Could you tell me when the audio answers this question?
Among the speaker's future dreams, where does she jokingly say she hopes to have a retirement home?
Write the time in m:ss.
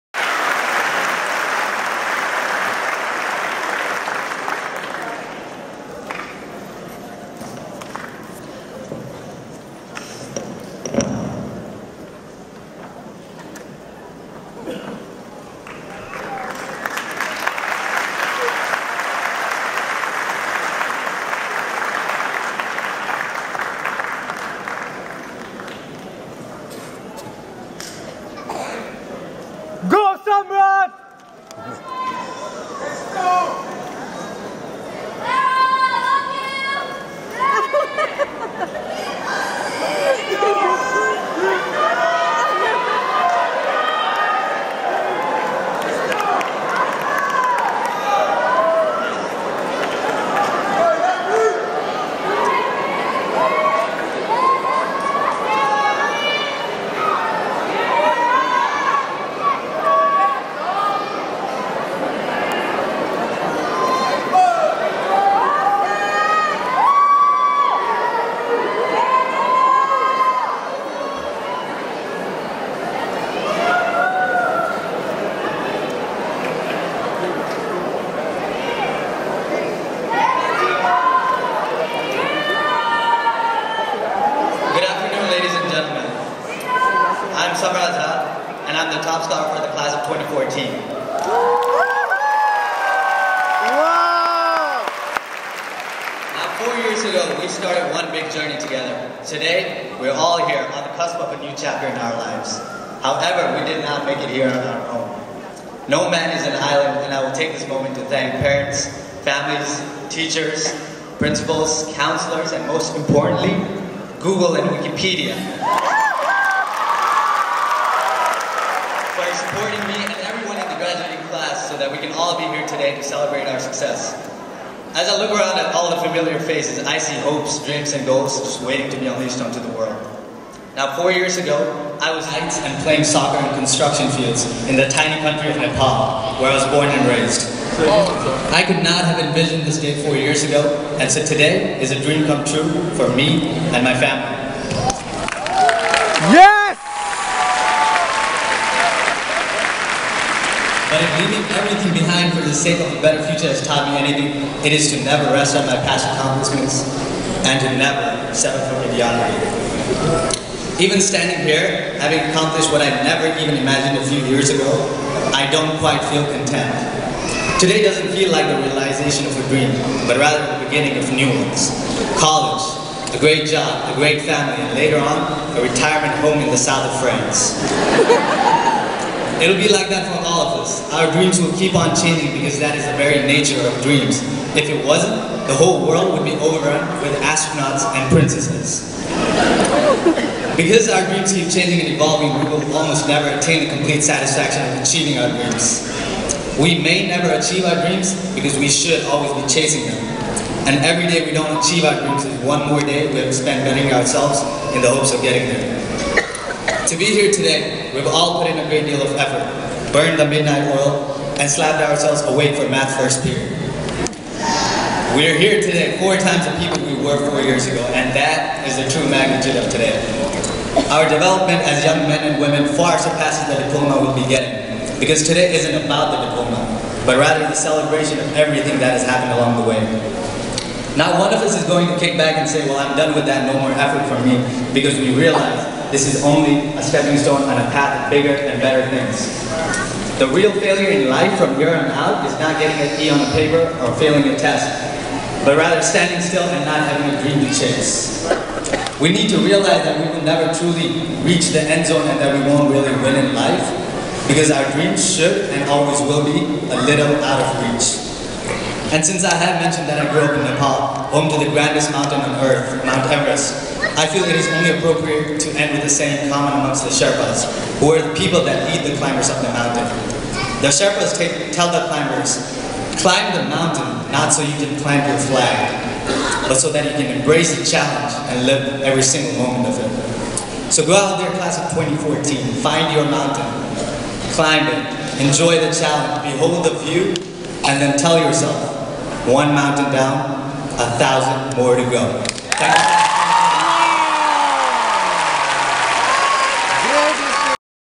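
2:56.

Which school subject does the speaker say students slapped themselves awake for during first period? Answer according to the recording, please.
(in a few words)
math.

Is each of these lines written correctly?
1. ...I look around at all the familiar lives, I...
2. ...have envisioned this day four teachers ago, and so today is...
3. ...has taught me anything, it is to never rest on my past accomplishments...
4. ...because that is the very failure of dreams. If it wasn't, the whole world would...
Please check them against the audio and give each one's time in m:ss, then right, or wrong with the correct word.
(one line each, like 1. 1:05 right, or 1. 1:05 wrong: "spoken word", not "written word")
1. 2:05 wrong: "faces", not "lives"
2. 2:19 wrong: "years", not "teachers"
3. 2:33 right
4. 3:02 wrong: "nature", not "failure".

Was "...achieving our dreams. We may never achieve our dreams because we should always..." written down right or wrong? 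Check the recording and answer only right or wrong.
right.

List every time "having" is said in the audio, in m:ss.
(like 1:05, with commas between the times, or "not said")
2:42, 4:06.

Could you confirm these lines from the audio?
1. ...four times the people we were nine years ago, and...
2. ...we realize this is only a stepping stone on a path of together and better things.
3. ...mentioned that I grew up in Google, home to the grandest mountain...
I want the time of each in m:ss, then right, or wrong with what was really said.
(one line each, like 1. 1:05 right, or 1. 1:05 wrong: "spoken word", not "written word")
1. 3:36 wrong: "four", not "nine"
2. 3:54 wrong: "bigger", not "together"
3. 4:19 wrong: "Nepal", not "Google".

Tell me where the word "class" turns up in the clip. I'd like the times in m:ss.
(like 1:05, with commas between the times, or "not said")
1:29, 2:01, 4:41.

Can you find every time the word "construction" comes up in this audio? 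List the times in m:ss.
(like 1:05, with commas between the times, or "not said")
2:13.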